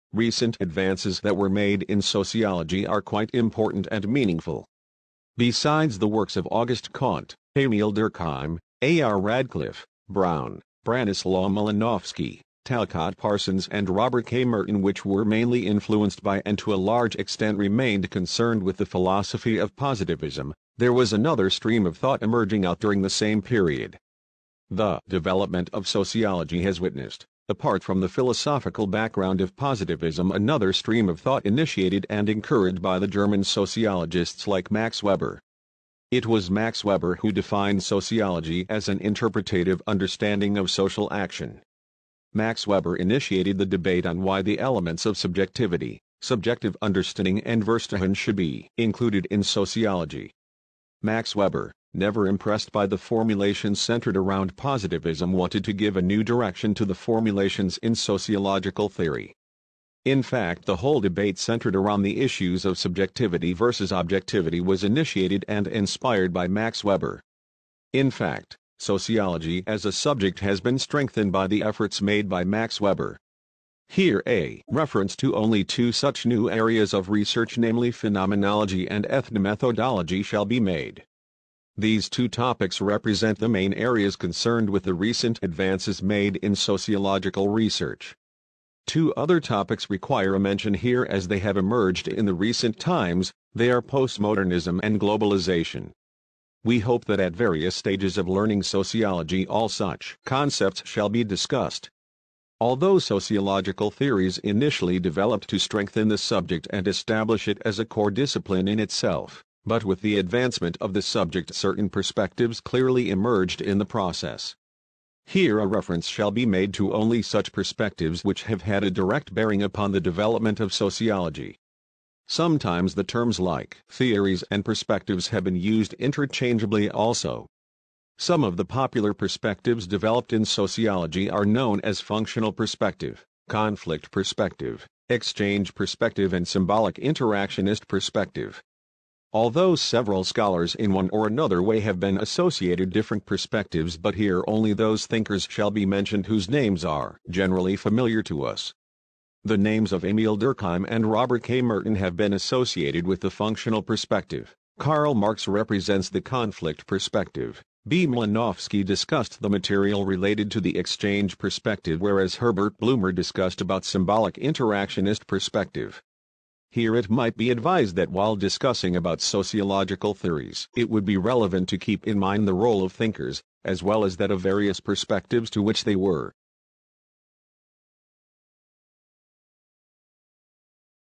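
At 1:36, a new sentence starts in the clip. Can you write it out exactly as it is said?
We hope that at various stages of learning sociology all such concepts shall be discussed.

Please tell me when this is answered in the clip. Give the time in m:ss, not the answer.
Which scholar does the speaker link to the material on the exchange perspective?
2:37.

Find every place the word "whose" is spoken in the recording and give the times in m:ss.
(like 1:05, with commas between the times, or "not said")
2:26.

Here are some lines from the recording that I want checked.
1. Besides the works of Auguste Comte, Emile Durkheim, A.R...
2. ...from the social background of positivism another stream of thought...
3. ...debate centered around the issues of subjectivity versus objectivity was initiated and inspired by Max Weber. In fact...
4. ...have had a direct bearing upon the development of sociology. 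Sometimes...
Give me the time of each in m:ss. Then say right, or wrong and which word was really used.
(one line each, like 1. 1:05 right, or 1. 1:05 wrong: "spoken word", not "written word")
1. 0:05 right
2. 0:27 wrong: "philosophical", not "social"
3. 1:01 right
4. 1:58 right.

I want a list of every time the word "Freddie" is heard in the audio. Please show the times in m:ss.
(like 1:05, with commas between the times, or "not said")
not said.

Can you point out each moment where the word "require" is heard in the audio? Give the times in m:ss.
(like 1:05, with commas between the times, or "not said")
1:29.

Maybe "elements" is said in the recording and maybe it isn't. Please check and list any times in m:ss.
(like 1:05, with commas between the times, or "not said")
0:44.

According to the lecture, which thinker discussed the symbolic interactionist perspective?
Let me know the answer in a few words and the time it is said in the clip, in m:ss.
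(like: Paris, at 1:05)
Herbert Blumer, at 2:42.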